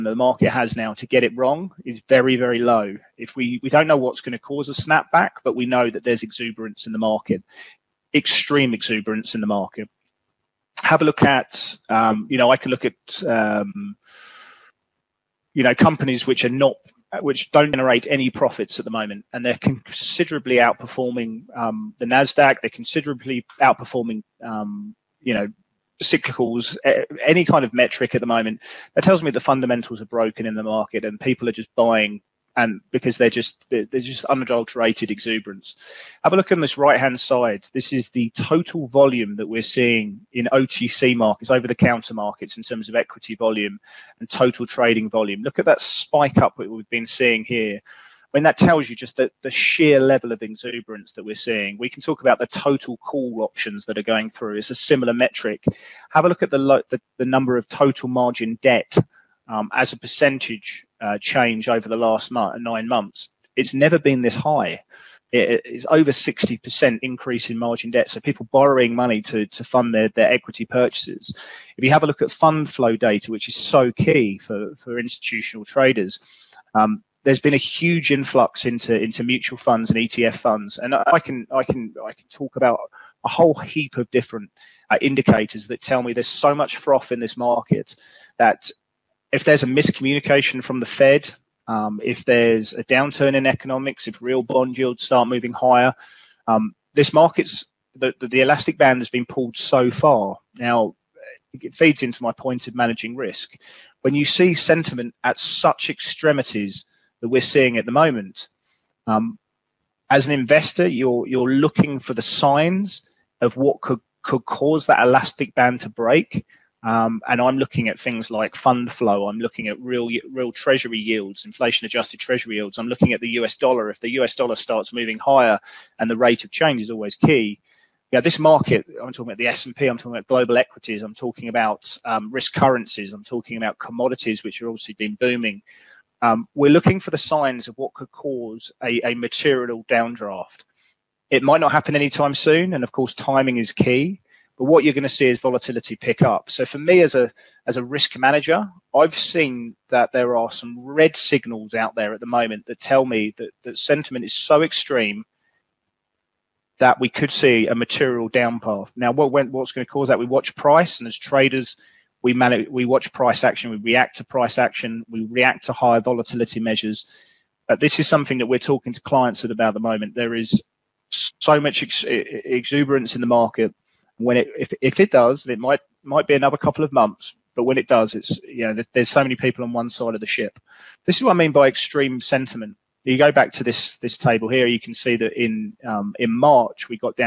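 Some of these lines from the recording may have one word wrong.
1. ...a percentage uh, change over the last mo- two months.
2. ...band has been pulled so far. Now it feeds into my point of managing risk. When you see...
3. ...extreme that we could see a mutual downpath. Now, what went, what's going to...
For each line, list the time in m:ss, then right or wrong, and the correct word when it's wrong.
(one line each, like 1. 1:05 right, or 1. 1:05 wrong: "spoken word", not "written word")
1. 0:59 wrong: "nine", not "two"
2. 1:38 right
3. 2:34 wrong: "material", not "mutual".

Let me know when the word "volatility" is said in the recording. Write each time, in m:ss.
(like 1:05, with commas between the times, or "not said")
2:25, 2:46.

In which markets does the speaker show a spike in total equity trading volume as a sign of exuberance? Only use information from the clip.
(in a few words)
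OTC markets.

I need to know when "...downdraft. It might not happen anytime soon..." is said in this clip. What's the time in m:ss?
2:19.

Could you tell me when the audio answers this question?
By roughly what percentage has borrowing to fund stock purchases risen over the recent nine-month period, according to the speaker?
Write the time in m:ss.
1:05.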